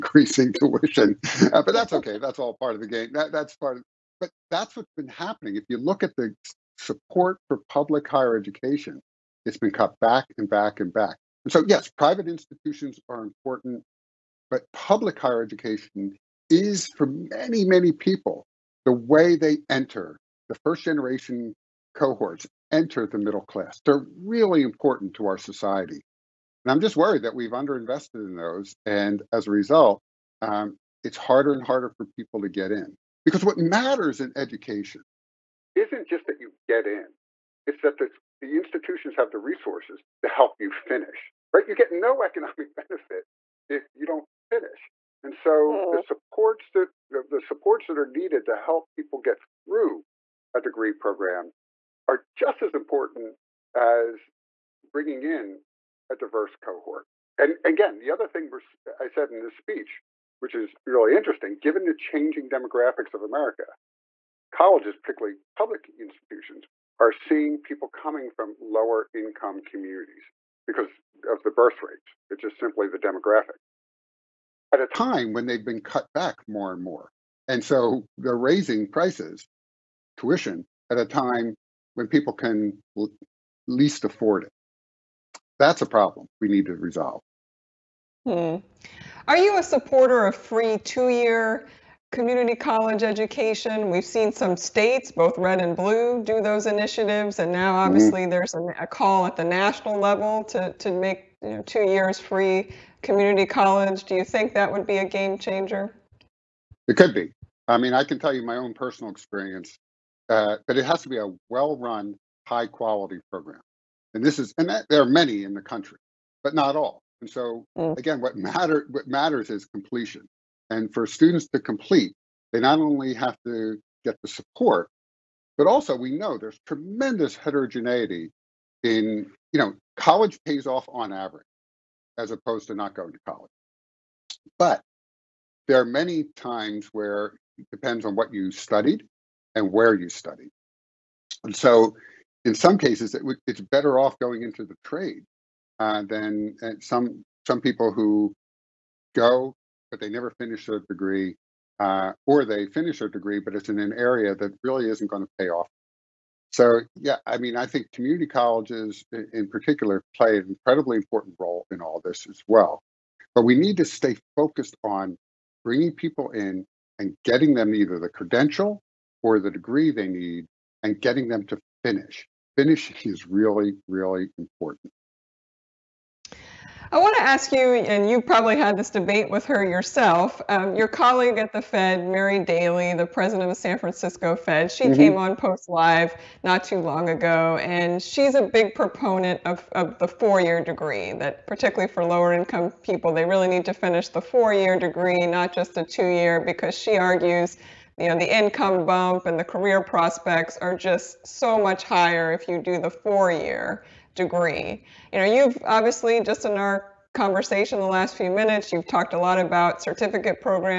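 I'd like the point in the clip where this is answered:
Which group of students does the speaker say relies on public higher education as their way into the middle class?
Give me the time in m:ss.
0:20.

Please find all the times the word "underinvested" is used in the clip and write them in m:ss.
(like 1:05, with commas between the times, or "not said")
0:27.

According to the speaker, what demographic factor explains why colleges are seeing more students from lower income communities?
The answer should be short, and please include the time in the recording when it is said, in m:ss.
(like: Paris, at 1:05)
Birth rates, at 1:11.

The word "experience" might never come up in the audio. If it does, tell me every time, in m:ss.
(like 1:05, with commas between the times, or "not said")
1:49.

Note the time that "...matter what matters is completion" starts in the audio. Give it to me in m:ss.
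1:58.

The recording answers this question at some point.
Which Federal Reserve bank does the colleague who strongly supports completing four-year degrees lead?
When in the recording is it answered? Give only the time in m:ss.
3:03.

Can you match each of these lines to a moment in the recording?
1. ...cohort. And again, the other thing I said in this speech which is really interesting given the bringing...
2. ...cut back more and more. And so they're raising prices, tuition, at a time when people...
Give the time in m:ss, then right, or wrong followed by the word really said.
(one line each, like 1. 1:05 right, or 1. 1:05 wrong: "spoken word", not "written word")
1. 0:56 wrong: "changing", not "bringing"
2. 1:15 right.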